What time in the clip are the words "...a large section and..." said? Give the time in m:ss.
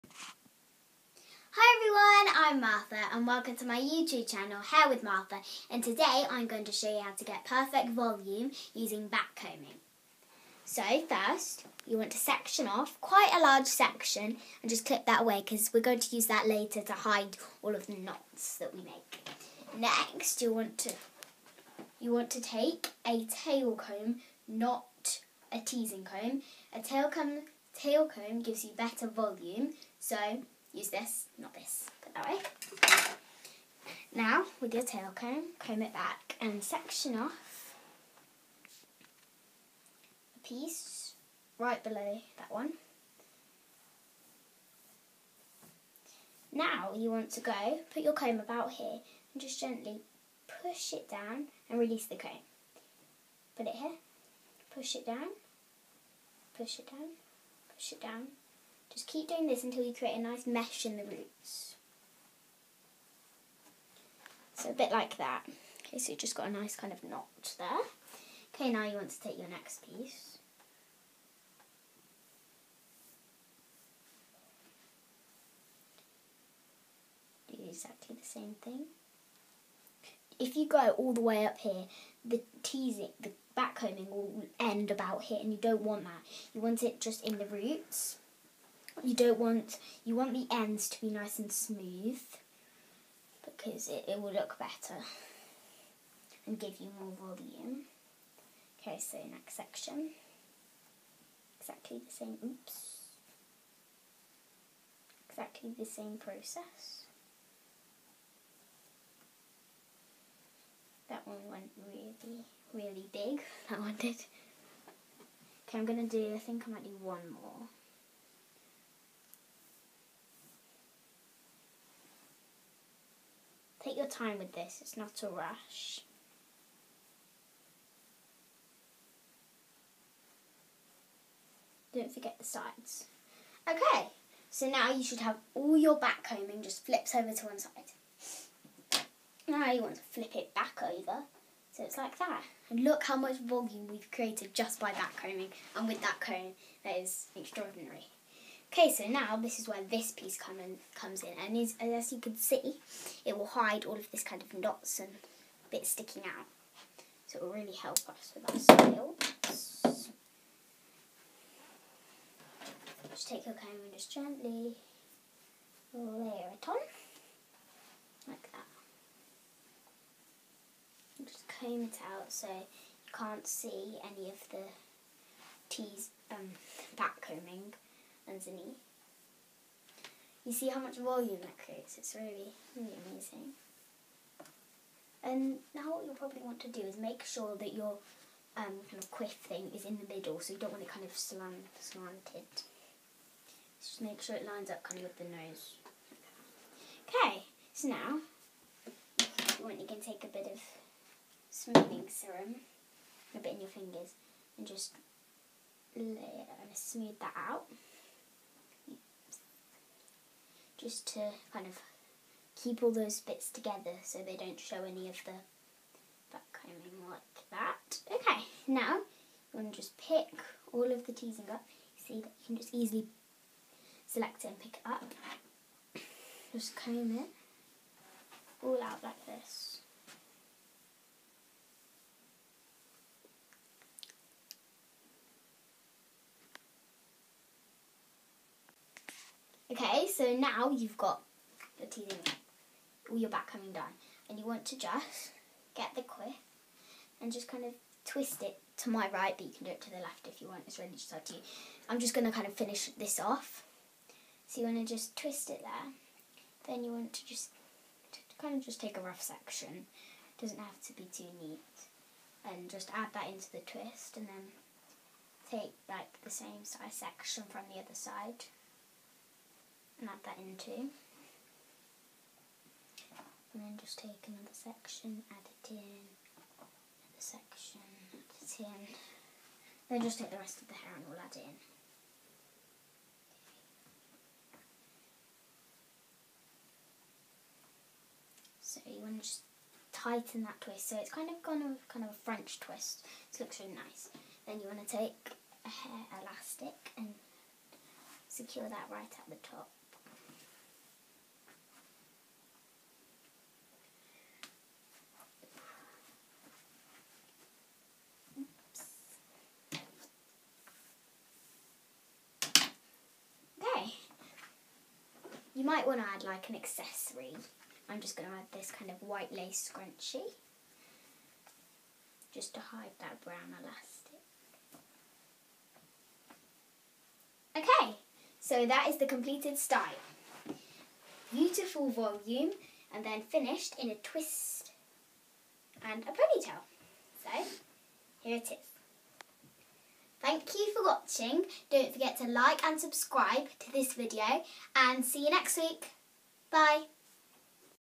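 0:13.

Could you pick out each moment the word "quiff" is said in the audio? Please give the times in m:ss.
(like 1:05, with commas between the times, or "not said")
3:09, 4:06.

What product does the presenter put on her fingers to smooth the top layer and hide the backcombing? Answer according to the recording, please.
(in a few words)
Smoothing serum.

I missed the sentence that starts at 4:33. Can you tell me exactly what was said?
And then just take another section, add it in, another section, add it in.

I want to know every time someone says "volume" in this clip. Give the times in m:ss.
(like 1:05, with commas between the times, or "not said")
0:07, 0:29, 1:37, 2:23, 3:00, 5:31.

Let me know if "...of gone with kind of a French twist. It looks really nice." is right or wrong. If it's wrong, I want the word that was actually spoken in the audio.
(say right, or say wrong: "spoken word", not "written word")
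right.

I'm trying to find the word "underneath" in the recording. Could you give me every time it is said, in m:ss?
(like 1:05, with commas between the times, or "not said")
2:58.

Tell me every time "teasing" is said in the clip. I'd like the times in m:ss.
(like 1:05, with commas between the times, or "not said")
0:25, 1:22, 3:41.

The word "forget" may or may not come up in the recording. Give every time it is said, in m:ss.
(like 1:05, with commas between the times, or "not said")
2:12, 5:41.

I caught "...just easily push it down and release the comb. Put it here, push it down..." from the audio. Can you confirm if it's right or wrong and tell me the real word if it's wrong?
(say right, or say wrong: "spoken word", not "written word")
wrong: "gently", not "easily".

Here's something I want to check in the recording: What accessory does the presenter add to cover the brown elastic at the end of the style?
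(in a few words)
White lace scrunchie.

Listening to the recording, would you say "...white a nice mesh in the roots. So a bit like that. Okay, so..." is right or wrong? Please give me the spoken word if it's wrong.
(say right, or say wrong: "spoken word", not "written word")
wrong: "create", not "white".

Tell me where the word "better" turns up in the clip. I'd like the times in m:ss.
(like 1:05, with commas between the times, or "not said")
0:28, 1:34.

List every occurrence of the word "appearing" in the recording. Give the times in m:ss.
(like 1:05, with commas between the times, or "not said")
not said.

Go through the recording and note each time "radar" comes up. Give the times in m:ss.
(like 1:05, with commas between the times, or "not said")
not said.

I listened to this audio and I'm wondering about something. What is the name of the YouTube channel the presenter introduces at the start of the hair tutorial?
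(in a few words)
Hair with Martha.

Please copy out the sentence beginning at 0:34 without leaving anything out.
Now, with your tail comb, comb it back and section off a piece right below that one.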